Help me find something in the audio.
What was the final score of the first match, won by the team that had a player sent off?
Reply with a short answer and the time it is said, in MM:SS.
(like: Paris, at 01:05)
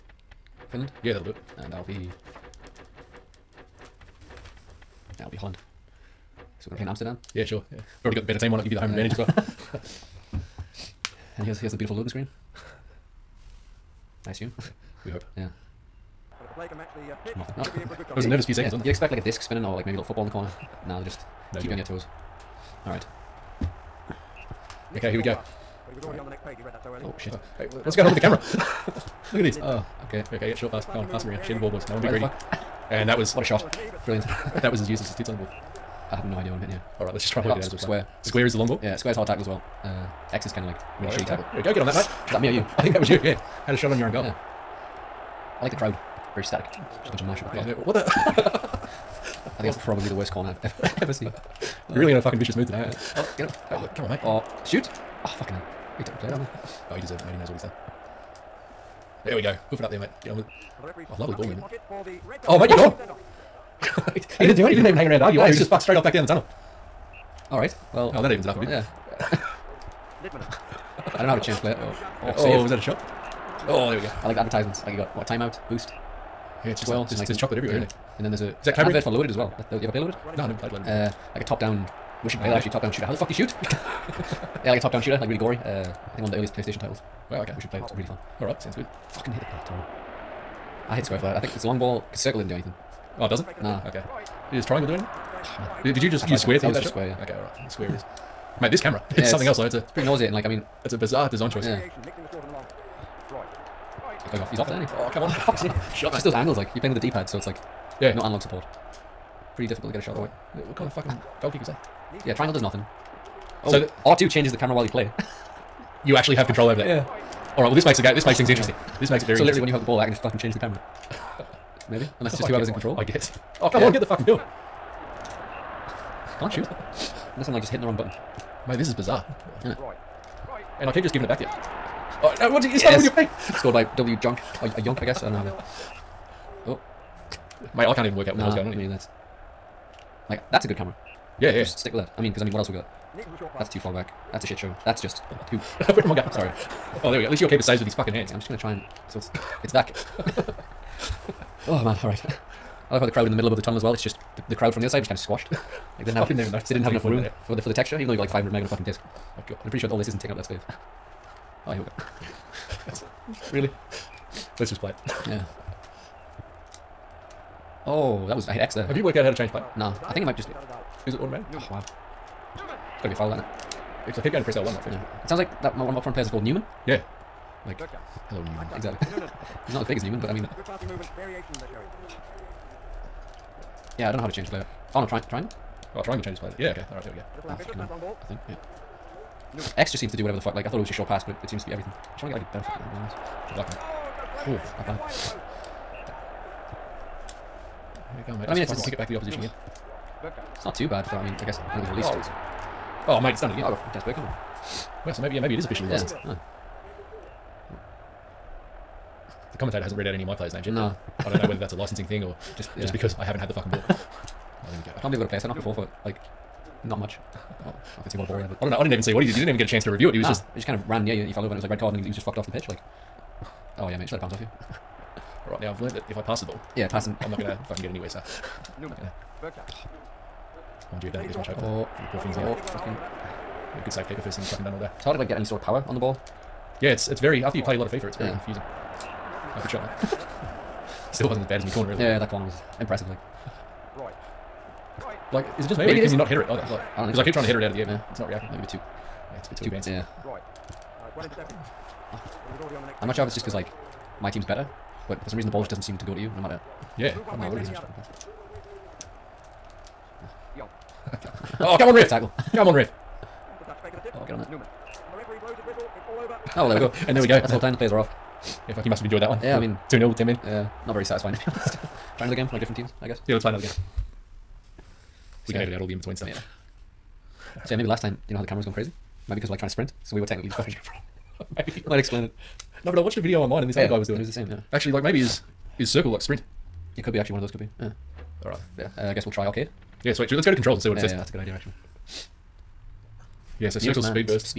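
2-0, at 04:29.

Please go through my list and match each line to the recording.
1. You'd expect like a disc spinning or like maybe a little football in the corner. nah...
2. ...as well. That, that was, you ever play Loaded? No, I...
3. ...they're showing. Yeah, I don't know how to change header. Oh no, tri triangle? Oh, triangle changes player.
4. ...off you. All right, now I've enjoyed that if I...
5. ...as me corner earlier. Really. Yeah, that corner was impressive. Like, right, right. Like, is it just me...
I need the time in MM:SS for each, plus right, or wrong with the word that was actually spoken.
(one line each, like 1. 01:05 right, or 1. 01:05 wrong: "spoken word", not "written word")
1. 00:18 right
2. 01:19 right
3. 03:01 wrong: "player", not "header"
4. 03:44 wrong: "learned", not "enjoyed"
5. 04:01 right.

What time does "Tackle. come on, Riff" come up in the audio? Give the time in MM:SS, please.
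04:22.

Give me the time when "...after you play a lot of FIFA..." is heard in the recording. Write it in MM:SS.
03:57.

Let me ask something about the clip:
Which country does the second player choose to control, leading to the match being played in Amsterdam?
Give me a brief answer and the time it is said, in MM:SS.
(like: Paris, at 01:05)
Holland, at 00:05.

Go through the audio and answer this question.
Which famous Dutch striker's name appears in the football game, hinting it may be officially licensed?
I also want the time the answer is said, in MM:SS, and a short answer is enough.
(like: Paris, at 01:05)
Dennis Bergkamp, at 03:23.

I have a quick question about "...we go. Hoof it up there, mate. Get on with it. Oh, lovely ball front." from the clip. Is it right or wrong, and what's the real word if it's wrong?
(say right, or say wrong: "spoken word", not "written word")
wrong: "movement", not "front".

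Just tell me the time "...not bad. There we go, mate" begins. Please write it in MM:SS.
03:14.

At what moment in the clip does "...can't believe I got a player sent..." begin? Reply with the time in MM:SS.
03:35.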